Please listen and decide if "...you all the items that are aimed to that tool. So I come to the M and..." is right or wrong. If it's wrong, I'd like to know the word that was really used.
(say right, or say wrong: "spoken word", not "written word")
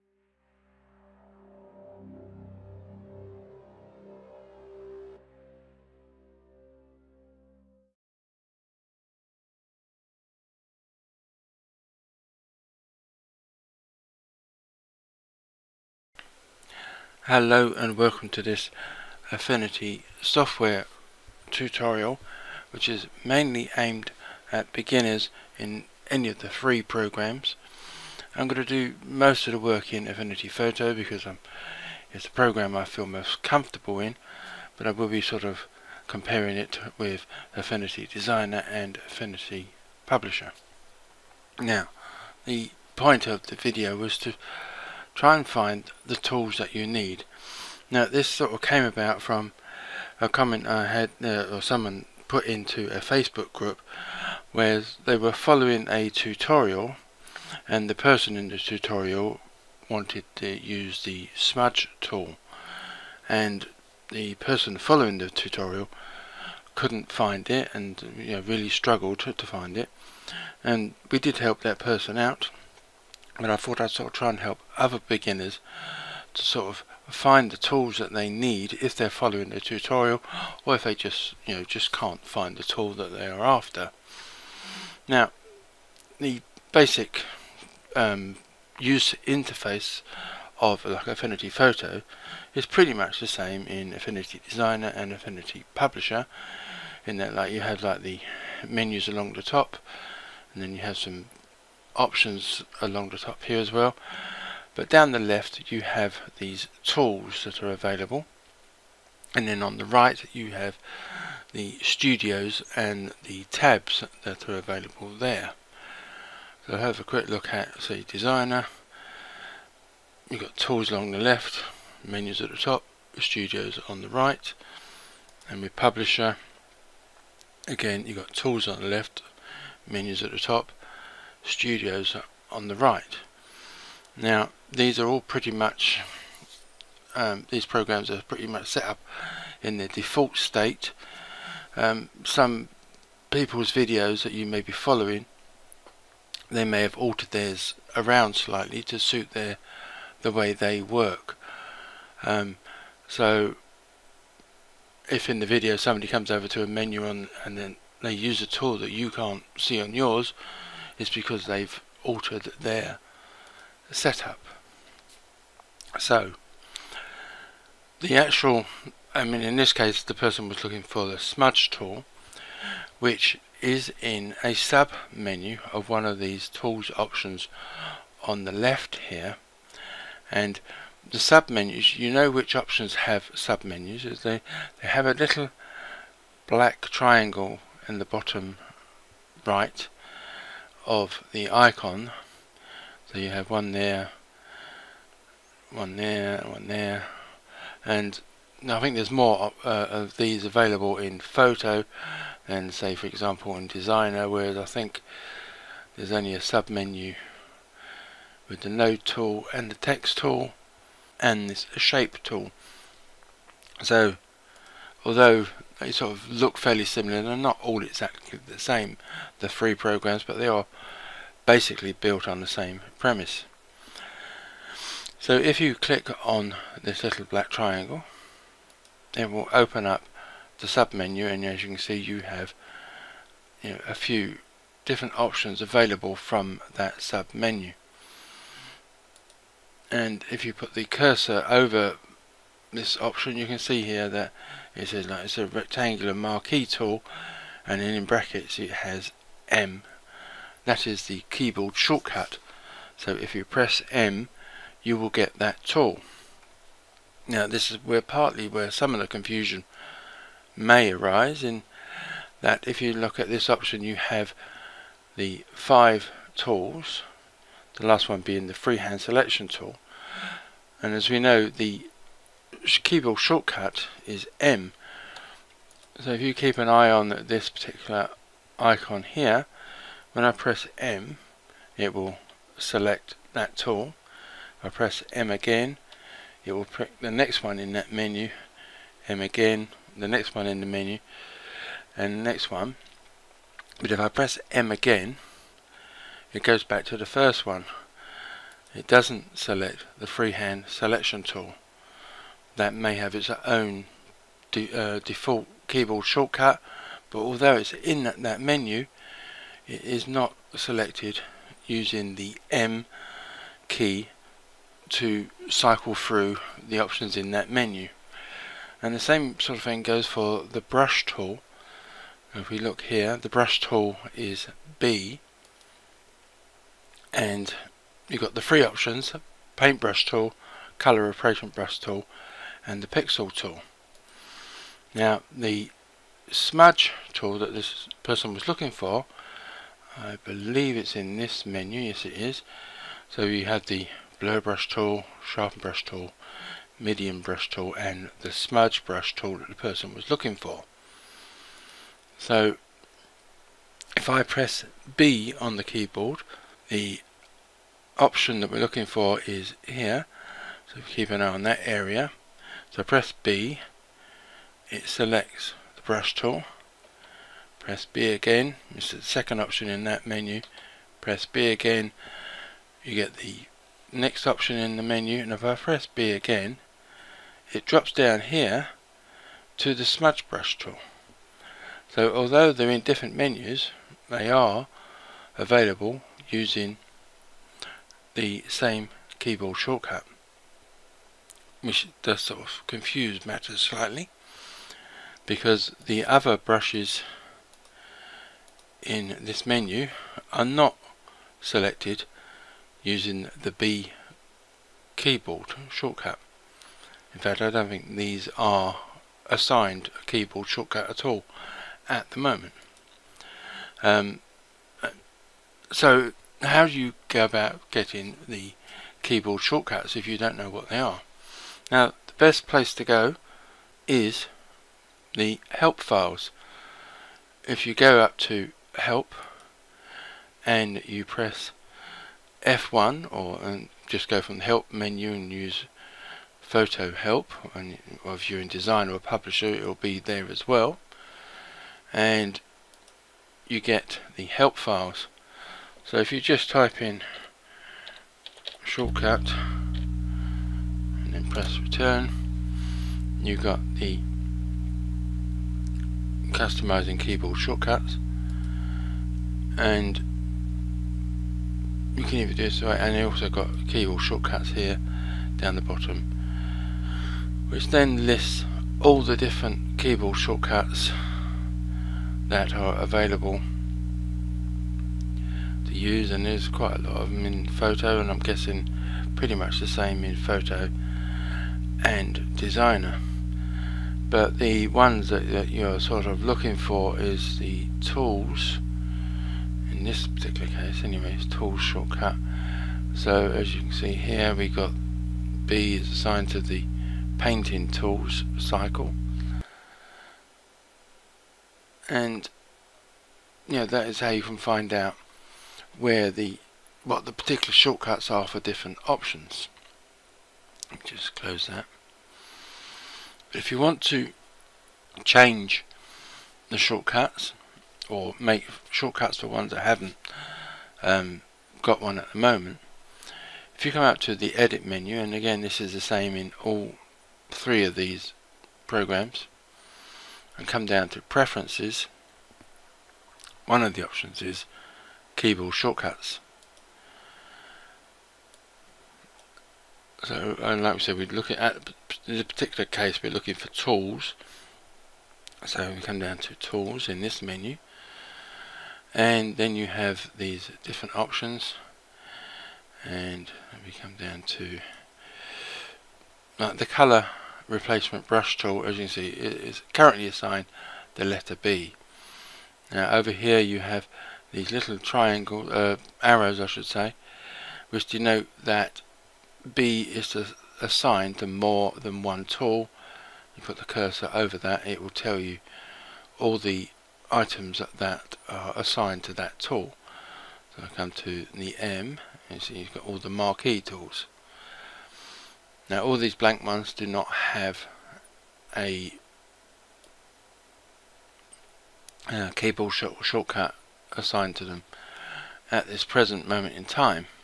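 wrong: "assigned", not "aimed".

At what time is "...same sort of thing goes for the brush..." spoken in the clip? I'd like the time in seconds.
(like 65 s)
318 s.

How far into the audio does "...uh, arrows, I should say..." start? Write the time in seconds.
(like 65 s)
565 s.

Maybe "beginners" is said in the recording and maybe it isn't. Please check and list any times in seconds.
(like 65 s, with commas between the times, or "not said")
24 s, 75 s.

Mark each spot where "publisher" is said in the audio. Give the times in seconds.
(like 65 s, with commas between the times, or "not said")
40 s, 95 s, 125 s, 439 s.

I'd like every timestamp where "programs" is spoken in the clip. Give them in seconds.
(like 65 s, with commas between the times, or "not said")
26 s, 32 s, 137 s, 219 s, 528 s.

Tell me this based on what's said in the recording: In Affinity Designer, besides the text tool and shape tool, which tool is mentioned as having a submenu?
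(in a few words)
node tool.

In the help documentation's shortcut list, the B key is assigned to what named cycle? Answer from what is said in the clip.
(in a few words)
painting tools cycle.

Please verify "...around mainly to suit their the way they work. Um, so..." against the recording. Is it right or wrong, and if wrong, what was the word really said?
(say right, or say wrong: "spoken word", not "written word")
wrong: "slightly", not "mainly".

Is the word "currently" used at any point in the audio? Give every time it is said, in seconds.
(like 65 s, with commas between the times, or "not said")
559 s.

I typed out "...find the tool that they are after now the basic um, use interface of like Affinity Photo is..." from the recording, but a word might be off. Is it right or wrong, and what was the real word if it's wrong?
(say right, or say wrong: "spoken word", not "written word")
right.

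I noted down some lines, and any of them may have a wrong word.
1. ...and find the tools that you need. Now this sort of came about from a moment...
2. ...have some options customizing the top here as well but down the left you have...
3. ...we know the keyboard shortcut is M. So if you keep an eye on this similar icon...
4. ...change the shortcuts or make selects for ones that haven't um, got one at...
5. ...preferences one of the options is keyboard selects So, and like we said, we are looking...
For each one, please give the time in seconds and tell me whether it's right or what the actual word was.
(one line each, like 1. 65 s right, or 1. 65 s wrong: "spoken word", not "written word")
1. 45 s wrong: "comment", not "moment"
2. 100 s wrong: "along", not "customizing"
3. 271 s wrong: "particular", not "similar"
4. 515 s wrong: "shortcuts", not "selects"
5. 531 s wrong: "shortcuts", not "selects".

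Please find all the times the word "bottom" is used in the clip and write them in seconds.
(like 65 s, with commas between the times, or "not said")
188 s, 465 s.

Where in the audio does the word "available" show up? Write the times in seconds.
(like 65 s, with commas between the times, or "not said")
107 s, 114 s, 200 s, 235 s, 385 s, 472 s.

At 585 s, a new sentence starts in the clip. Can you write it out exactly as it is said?
Now all these blank ones do not have a uh, keyboard sh shortcut assigned to them at this present moment in time.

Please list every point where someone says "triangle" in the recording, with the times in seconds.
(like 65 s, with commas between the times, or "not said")
186 s, 227 s, 564 s.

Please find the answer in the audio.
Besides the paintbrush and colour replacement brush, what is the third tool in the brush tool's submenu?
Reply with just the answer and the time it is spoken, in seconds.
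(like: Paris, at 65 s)
pixel tool, at 332 s.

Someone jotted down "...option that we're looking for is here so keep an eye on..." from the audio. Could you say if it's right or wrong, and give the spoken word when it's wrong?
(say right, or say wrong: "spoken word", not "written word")
right.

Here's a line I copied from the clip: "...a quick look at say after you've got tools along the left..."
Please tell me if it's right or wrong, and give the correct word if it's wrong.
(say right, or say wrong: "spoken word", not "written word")
wrong: "designer", not "after".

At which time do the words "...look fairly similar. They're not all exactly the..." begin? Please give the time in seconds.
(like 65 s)
216 s.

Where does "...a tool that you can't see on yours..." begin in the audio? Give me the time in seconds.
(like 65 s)
158 s.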